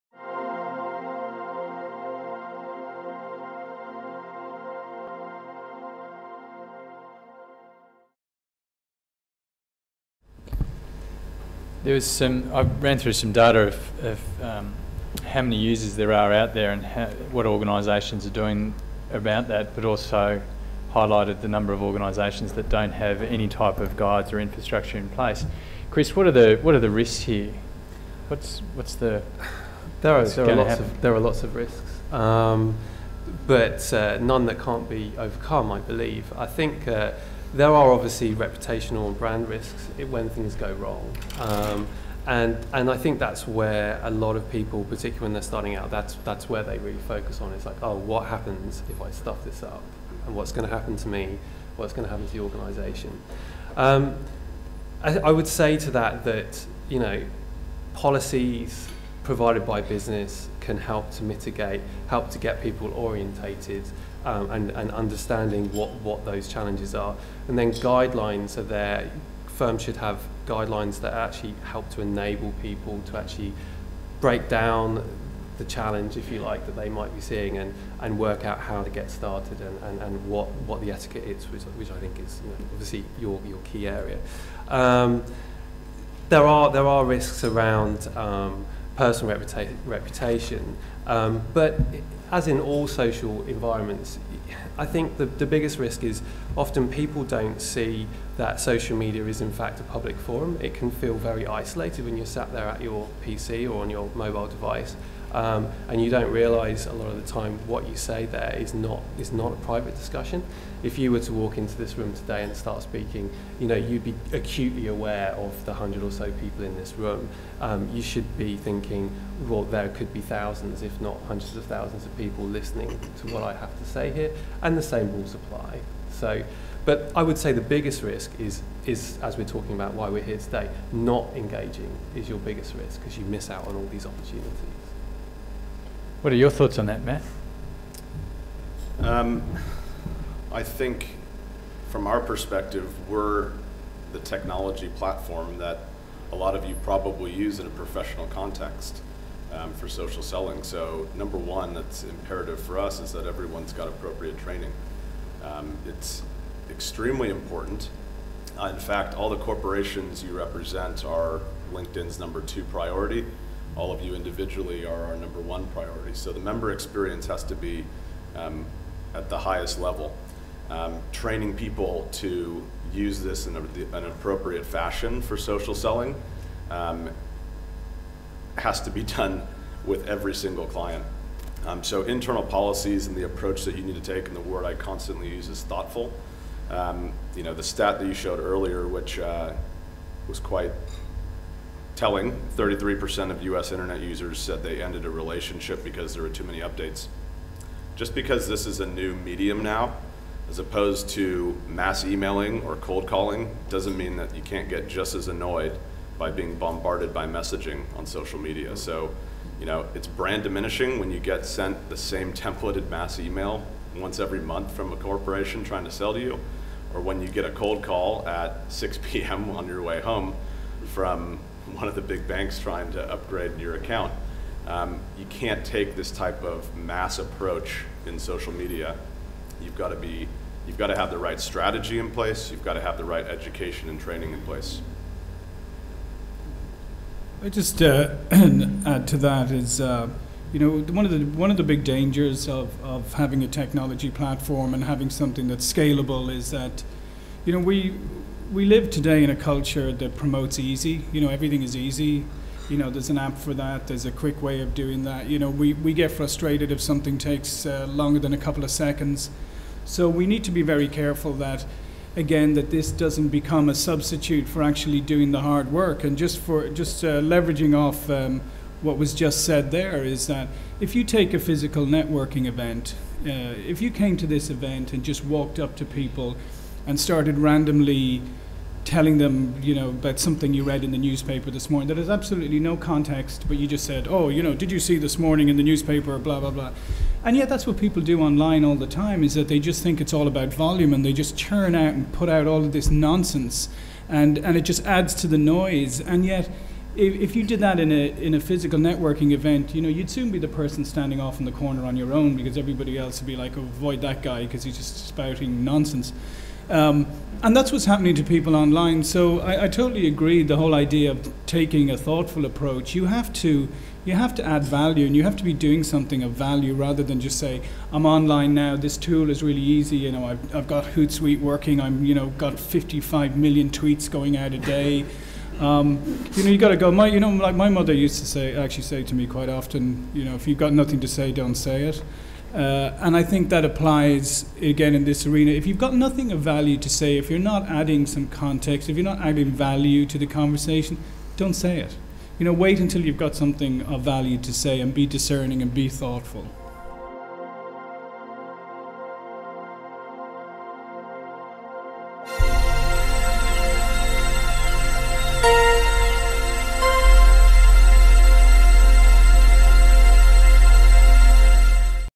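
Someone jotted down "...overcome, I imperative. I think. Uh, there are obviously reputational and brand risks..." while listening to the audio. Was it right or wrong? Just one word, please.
wrong.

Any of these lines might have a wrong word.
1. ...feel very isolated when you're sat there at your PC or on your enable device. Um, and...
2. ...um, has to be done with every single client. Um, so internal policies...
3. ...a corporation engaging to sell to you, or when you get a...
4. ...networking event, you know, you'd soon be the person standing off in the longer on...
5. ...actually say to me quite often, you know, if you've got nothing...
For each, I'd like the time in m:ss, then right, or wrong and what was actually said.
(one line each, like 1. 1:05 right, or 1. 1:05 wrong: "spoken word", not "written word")
1. 1:40 wrong: "mobile", not "enable"
2. 2:56 right
3. 3:34 wrong: "trying", not "engaging"
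4. 4:58 wrong: "corner", not "longer"
5. 5:28 right.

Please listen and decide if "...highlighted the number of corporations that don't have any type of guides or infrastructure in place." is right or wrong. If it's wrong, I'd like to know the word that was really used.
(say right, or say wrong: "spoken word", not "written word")
wrong: "organisations", not "corporations".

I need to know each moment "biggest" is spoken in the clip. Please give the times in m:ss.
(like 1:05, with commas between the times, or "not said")
1:35, 2:07, 2:12.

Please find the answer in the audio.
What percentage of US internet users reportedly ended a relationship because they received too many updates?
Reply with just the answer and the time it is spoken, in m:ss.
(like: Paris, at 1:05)
33%, at 3:12.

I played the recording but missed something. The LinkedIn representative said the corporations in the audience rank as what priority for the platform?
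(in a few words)
Number two.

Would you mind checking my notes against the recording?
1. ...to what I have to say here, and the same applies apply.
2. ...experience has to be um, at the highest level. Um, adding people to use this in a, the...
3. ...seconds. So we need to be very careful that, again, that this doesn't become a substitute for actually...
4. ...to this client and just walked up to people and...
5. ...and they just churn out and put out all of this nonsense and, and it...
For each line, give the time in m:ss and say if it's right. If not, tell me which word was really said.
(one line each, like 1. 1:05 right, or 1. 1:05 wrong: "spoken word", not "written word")
1. 2:03 wrong: "rules", not "applies"
2. 2:46 wrong: "training", not "adding"
3. 4:18 right
4. 4:34 wrong: "event", not "client"
5. 4:50 right.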